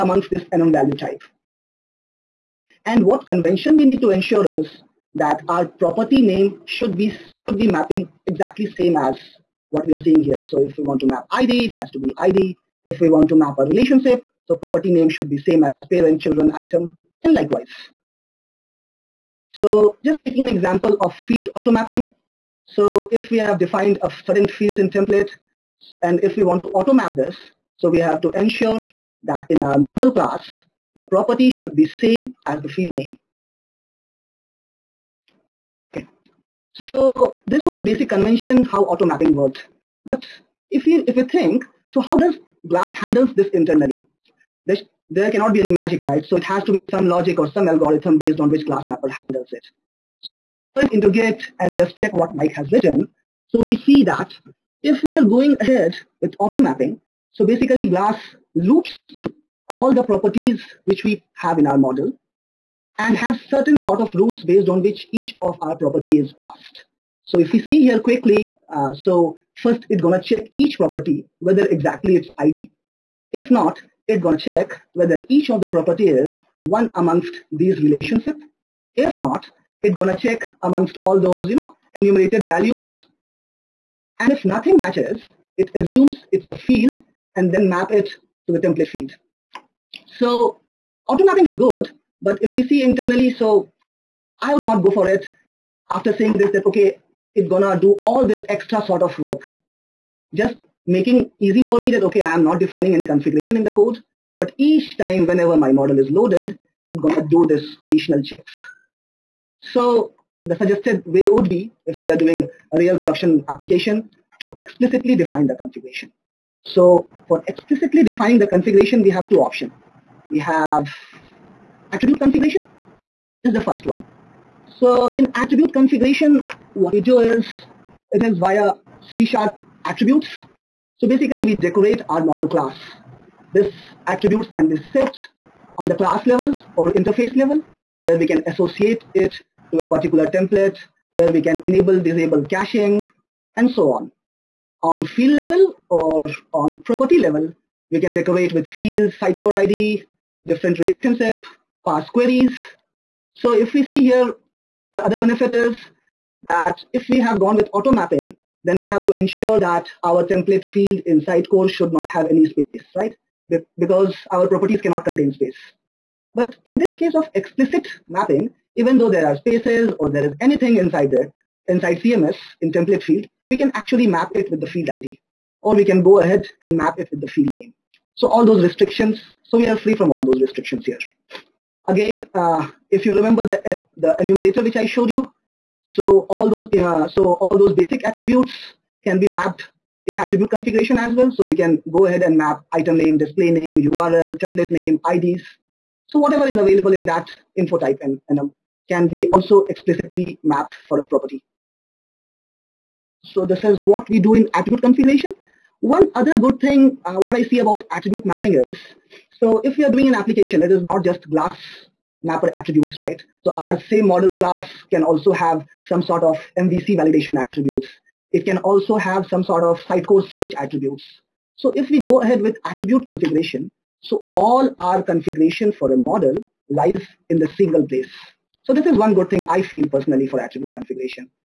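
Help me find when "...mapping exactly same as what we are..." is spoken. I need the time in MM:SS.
00:07.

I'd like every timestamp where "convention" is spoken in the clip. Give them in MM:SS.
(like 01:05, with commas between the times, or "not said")
00:03, 00:38.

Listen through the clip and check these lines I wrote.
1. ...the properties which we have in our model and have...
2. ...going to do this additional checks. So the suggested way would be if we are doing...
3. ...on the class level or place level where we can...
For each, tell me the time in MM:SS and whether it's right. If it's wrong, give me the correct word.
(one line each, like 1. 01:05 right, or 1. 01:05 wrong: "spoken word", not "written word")
1. 00:59 right
2. 01:46 right
3. 02:15 wrong: "interface", not "place".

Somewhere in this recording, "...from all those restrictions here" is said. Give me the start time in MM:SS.
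02:59.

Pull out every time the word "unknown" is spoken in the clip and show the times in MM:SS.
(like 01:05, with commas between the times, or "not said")
00:00.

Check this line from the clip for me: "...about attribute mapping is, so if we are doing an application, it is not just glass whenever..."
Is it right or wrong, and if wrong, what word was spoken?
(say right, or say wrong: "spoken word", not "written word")
wrong: "mapper", not "whenever".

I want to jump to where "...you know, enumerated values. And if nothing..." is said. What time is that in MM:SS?
01:21.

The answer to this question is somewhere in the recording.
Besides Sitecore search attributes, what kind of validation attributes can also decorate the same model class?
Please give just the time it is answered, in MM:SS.
03:36.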